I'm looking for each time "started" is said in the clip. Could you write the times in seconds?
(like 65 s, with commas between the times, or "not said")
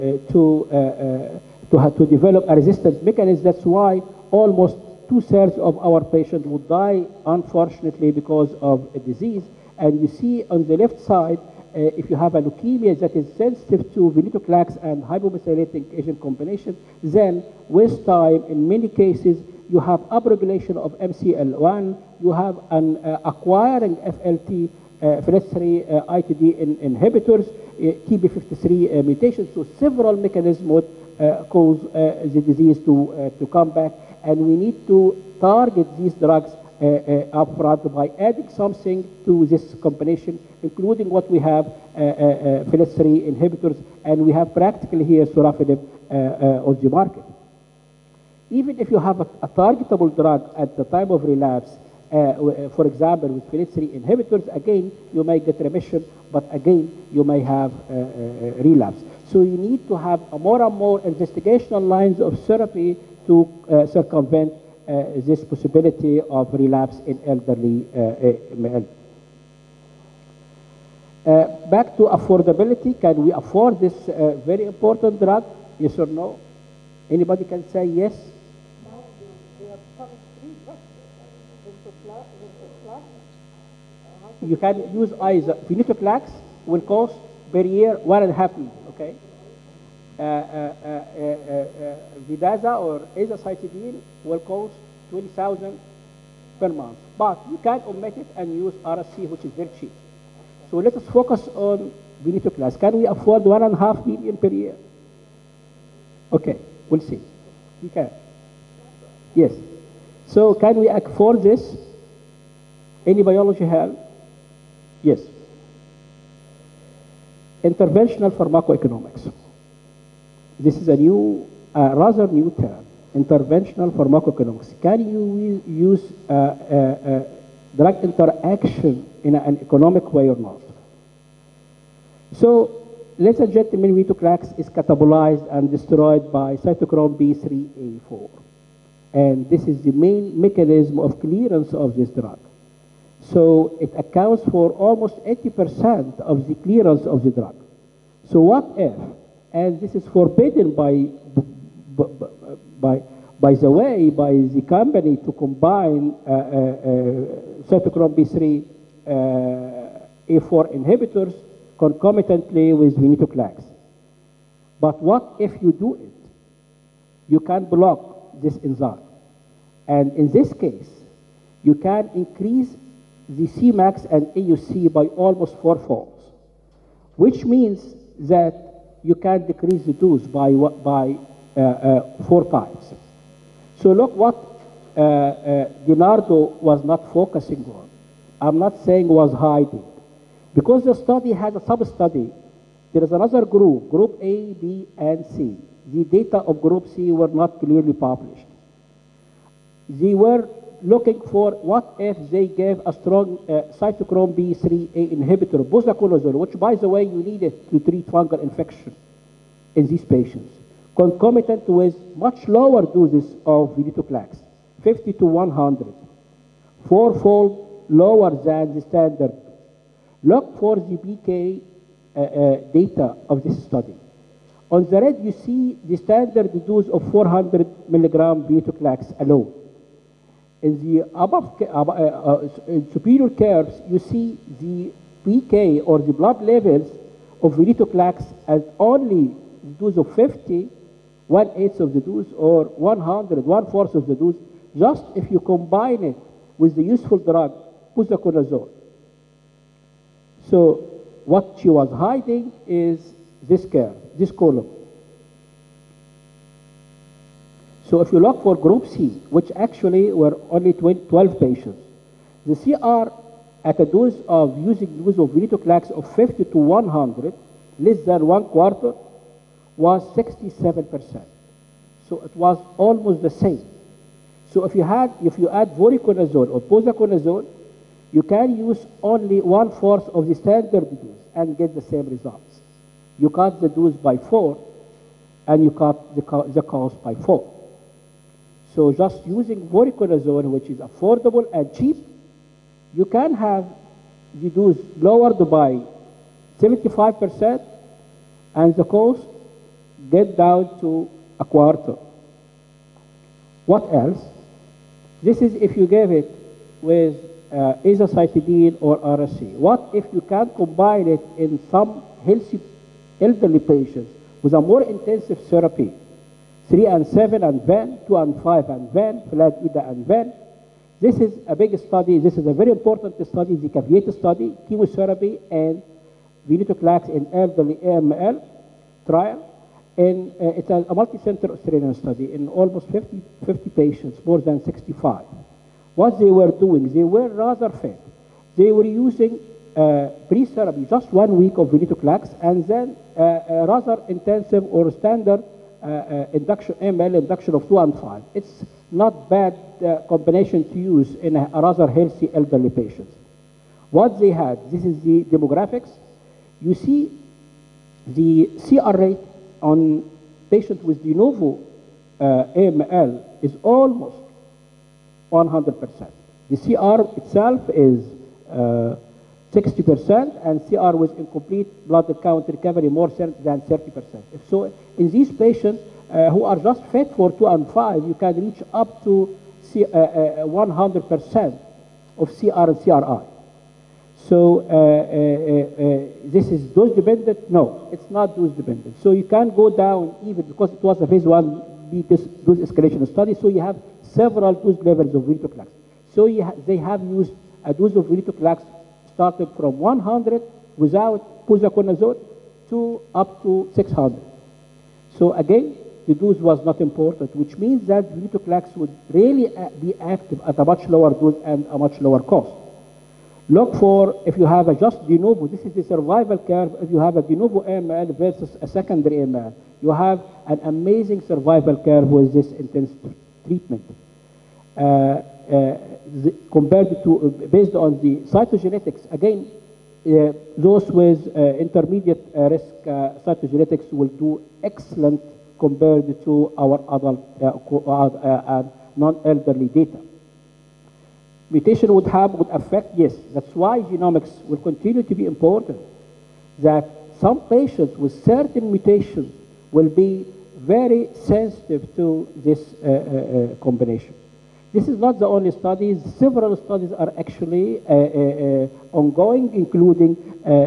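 399 s.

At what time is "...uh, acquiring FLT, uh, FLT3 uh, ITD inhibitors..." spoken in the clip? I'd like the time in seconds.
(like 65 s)
23 s.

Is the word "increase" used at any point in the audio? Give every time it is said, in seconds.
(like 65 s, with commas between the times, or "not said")
172 s.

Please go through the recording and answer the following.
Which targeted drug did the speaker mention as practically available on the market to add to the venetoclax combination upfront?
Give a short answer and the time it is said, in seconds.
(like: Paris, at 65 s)
sorafenib, at 45 s.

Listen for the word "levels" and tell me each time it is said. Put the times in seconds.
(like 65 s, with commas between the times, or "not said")
236 s, 394 s.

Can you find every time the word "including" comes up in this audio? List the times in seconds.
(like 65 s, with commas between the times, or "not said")
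40 s, 459 s.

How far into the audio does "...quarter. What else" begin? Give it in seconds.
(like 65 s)
301 s.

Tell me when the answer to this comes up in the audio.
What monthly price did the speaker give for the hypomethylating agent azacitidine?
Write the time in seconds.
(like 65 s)
95 s.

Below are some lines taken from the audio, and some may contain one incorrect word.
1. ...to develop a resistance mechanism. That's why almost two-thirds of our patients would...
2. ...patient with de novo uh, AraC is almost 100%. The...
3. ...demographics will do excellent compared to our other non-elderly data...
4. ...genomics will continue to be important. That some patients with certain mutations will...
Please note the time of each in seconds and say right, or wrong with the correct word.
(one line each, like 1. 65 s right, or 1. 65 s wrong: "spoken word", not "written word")
1. 1 s right
2. 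360 s wrong: "AML", not "AraC"
3. 433 s wrong: "cytogenetics", not "demographics"
4. 443 s right.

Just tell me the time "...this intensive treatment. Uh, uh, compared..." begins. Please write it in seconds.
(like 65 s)
422 s.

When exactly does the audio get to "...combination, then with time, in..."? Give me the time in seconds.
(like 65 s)
16 s.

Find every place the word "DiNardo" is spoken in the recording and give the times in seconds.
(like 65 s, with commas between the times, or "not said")
185 s.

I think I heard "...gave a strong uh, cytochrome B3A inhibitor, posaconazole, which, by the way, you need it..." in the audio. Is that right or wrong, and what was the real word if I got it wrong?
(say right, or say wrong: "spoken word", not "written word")
right.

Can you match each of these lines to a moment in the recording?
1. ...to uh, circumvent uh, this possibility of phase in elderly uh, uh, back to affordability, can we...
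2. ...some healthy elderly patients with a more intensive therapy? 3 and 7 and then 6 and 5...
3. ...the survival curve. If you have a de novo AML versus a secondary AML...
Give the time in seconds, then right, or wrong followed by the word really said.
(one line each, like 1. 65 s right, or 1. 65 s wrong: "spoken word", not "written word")
1. 63 s wrong: "relapse", not "phase"
2. 311 s wrong: "2", not "6"
3. 415 s right.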